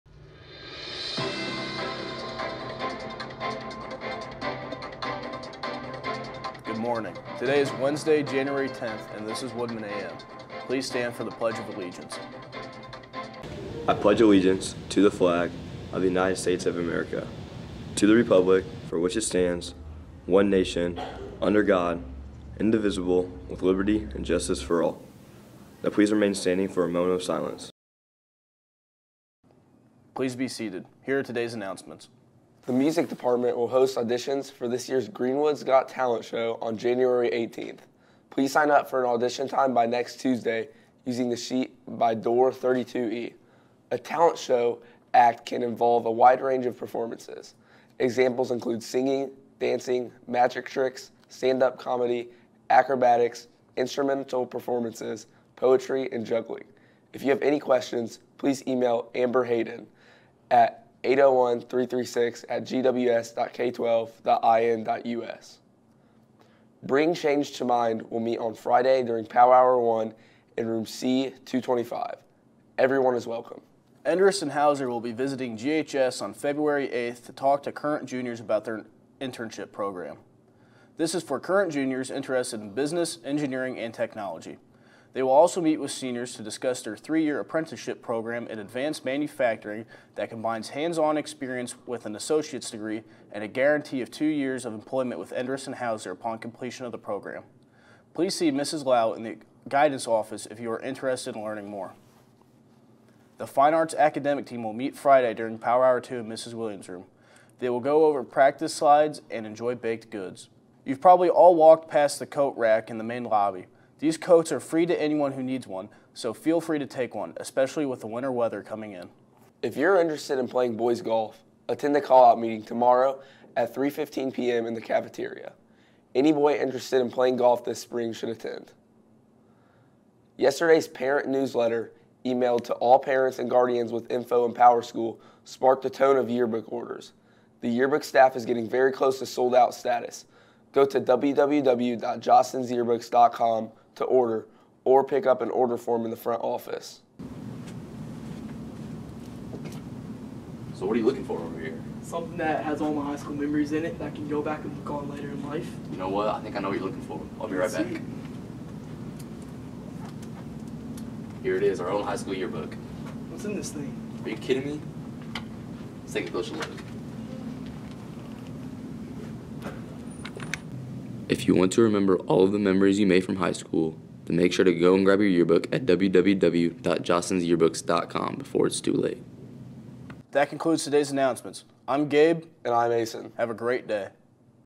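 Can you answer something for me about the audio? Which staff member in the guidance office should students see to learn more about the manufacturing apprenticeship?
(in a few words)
Mrs. Lau.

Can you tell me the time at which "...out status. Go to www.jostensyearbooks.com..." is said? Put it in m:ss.
2:19.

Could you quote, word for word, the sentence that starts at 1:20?
This is for current juniors interested in business, engineering, and technology.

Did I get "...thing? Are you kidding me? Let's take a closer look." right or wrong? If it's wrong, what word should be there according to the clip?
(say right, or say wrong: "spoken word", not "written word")
right.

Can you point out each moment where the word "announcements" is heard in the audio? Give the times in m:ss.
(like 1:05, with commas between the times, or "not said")
0:31, 3:01.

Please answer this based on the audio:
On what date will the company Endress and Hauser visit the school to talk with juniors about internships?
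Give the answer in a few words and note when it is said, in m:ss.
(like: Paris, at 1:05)
February 8th, at 1:16.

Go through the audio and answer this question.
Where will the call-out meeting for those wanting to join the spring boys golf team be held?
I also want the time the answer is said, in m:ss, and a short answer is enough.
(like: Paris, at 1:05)
the cafeteria, at 2:04.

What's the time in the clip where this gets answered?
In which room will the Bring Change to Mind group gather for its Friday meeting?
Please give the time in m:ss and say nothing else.
1:10.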